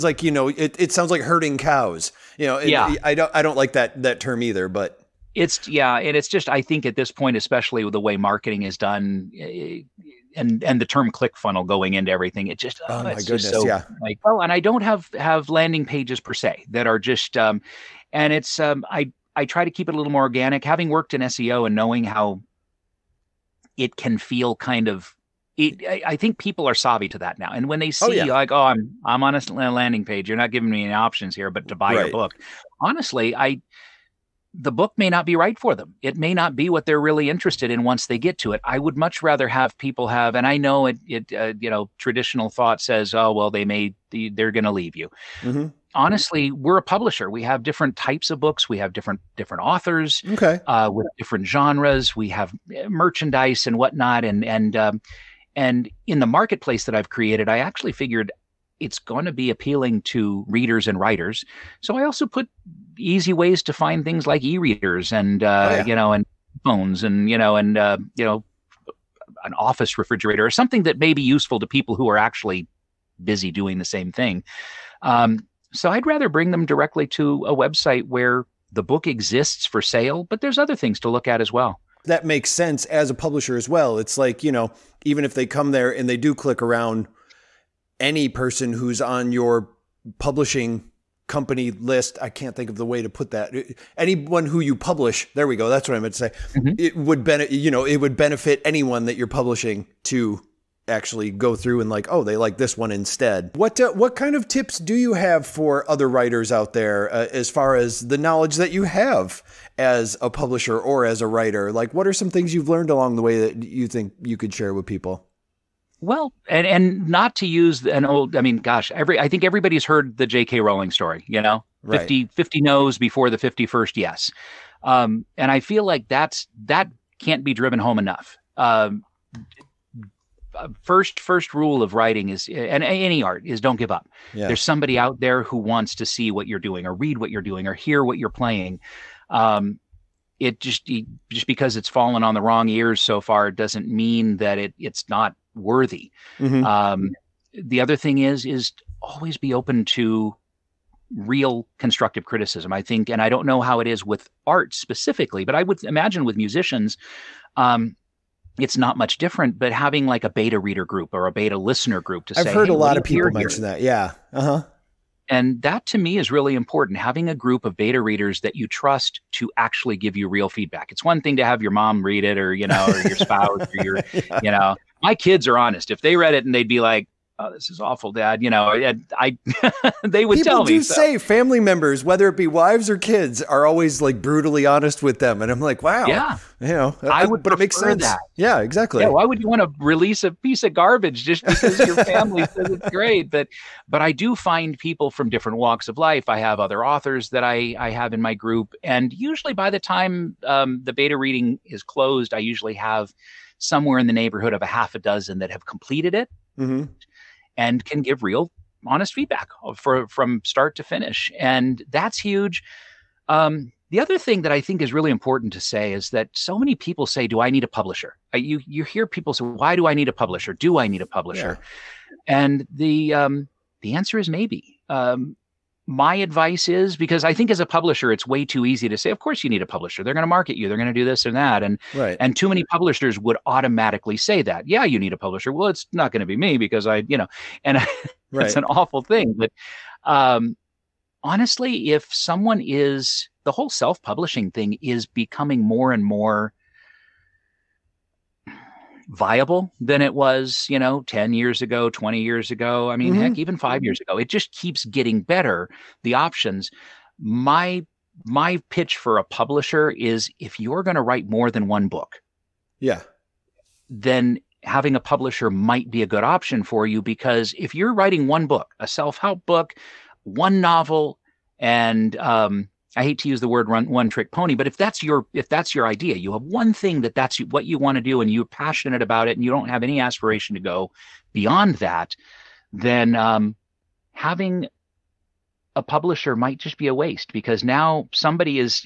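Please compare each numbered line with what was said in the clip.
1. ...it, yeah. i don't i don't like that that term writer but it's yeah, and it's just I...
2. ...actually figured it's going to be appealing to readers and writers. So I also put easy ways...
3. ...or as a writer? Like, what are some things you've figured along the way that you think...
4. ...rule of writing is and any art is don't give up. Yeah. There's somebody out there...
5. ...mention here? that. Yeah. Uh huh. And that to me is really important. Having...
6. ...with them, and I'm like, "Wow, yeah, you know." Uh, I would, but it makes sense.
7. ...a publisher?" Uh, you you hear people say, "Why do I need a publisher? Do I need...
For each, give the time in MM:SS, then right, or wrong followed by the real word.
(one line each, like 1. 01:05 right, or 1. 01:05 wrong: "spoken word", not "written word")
1. 00:02 wrong: "either", not "writer"
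2. 00:57 right
3. 01:50 wrong: "learned", not "figured"
4. 02:11 right
5. 02:43 right
6. 03:05 right
7. 03:37 right.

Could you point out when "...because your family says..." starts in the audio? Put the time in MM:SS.
03:11.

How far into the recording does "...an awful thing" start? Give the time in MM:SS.
03:58.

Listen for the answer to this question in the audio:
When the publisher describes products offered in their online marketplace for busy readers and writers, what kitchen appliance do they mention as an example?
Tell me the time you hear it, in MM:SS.
01:09.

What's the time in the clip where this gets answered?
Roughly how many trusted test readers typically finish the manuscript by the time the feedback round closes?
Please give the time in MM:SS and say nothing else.
03:24.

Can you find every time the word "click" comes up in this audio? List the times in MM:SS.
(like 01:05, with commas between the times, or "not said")
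00:11, 01:26.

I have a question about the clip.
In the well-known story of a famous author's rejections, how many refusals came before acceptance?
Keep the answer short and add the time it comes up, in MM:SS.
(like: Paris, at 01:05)
50, at 02:02.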